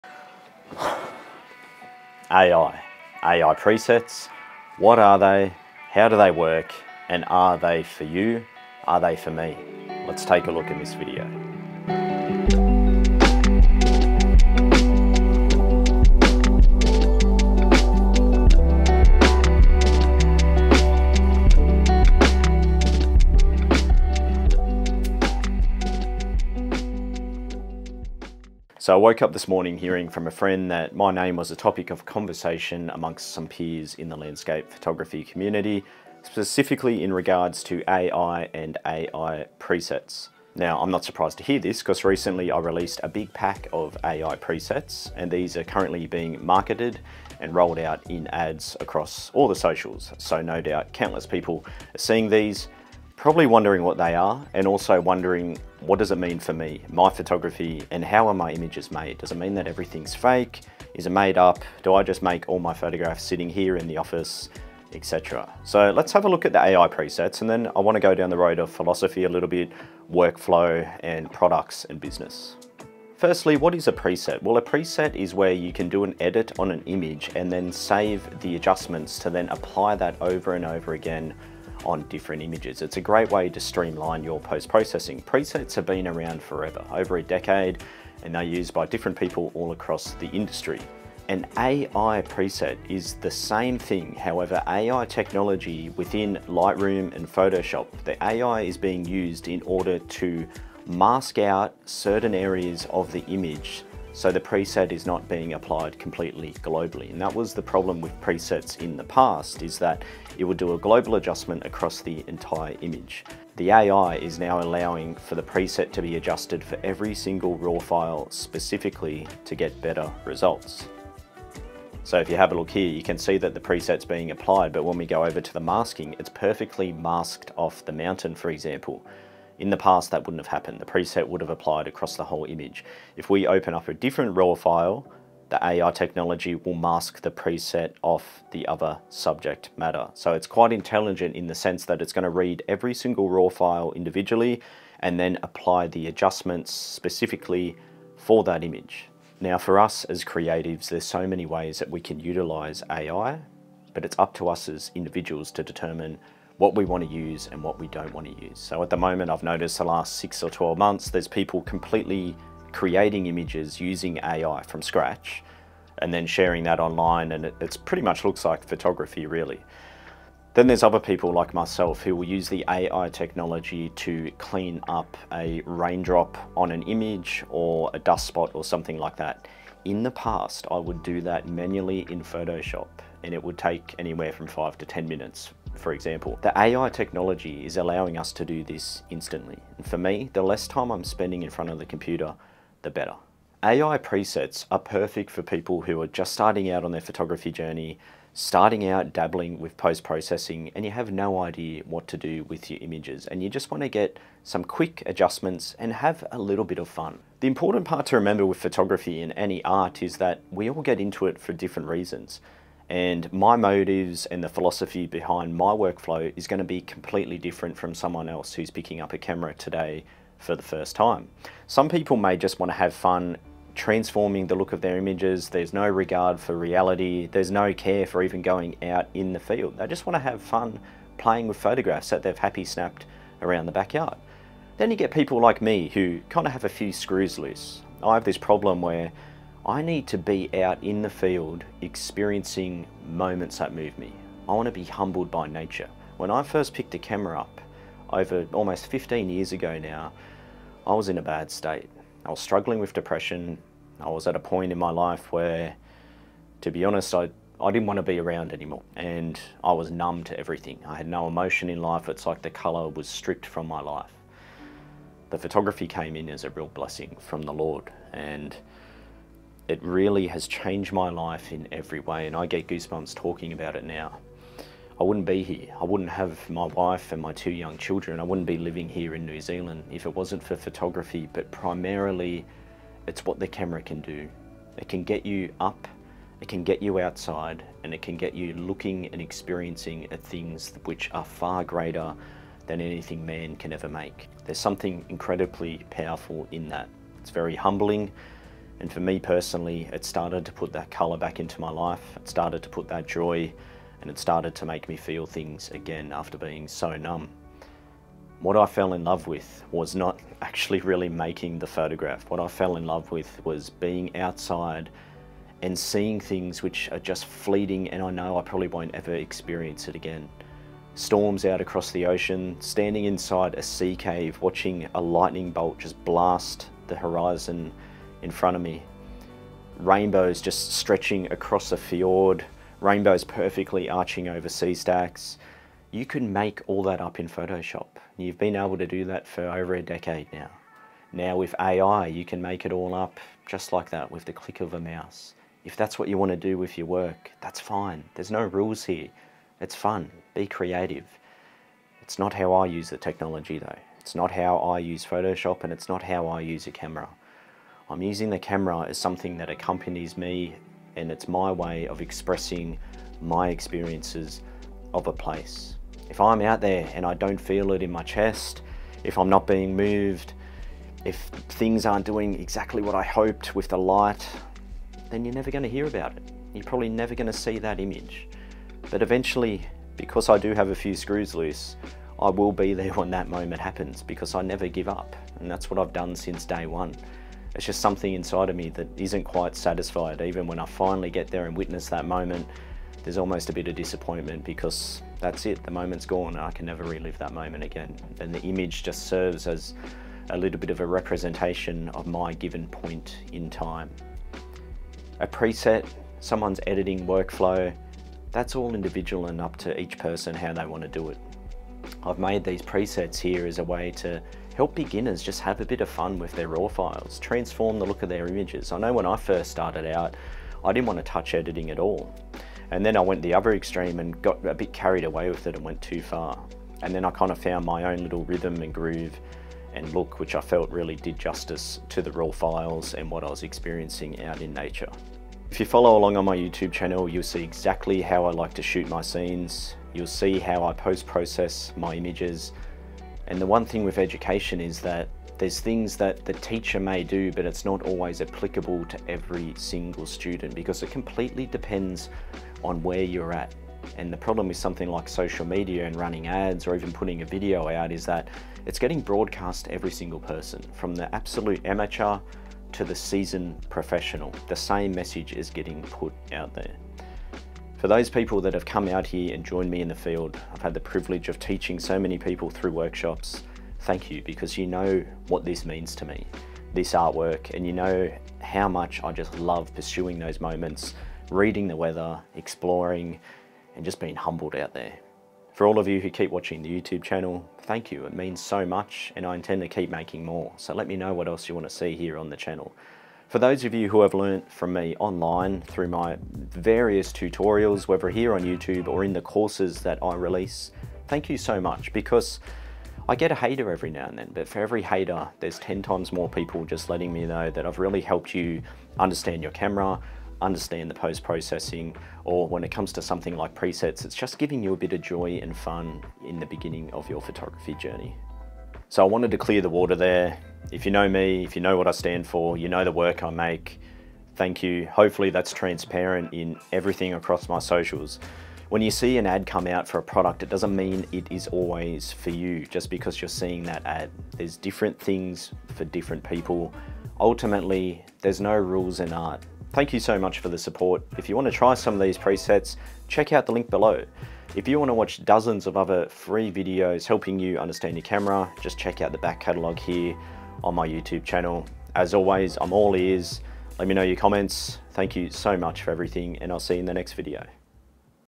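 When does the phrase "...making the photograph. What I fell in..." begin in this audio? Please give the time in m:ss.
5:11.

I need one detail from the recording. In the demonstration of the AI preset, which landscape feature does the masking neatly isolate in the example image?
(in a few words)
the mountain.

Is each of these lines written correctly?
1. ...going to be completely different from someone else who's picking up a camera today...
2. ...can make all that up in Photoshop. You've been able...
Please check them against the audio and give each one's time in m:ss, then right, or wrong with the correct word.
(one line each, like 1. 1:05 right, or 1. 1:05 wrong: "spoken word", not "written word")
1. 3:36 right
2. 5:36 right.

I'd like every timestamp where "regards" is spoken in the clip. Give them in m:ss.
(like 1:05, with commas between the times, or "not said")
0:37, 3:45.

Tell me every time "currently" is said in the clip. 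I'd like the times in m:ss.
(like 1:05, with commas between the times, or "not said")
0:45.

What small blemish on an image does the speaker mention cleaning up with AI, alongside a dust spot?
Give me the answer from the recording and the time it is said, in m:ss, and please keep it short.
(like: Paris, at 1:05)
a raindrop, at 2:55.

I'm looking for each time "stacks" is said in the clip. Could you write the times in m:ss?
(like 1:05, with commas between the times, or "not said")
5:34.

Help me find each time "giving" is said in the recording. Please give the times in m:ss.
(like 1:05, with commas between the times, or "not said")
8:34.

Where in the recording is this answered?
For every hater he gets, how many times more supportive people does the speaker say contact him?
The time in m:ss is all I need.
8:25.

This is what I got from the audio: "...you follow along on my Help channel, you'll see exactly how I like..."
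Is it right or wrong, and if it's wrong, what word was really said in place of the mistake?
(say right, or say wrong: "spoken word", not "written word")
wrong: "YouTube", not "Help".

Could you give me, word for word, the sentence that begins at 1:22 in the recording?
It's a great way to streamline your post-processing.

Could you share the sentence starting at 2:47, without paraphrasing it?
And it it's pretty much looks like photography really.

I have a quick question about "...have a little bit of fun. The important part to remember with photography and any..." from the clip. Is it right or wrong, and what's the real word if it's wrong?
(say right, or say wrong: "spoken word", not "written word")
right.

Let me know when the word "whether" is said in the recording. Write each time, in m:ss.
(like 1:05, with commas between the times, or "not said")
8:17.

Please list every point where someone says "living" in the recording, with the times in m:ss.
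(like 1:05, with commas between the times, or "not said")
4:38.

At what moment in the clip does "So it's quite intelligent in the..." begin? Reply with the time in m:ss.
2:20.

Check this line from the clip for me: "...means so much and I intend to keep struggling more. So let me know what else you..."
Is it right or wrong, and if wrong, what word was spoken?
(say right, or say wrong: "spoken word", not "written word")
wrong: "making", not "struggling".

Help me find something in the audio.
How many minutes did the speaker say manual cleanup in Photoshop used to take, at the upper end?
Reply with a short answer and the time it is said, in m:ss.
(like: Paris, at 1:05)
10 minutes, at 3:04.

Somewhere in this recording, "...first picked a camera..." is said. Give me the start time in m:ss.
4:06.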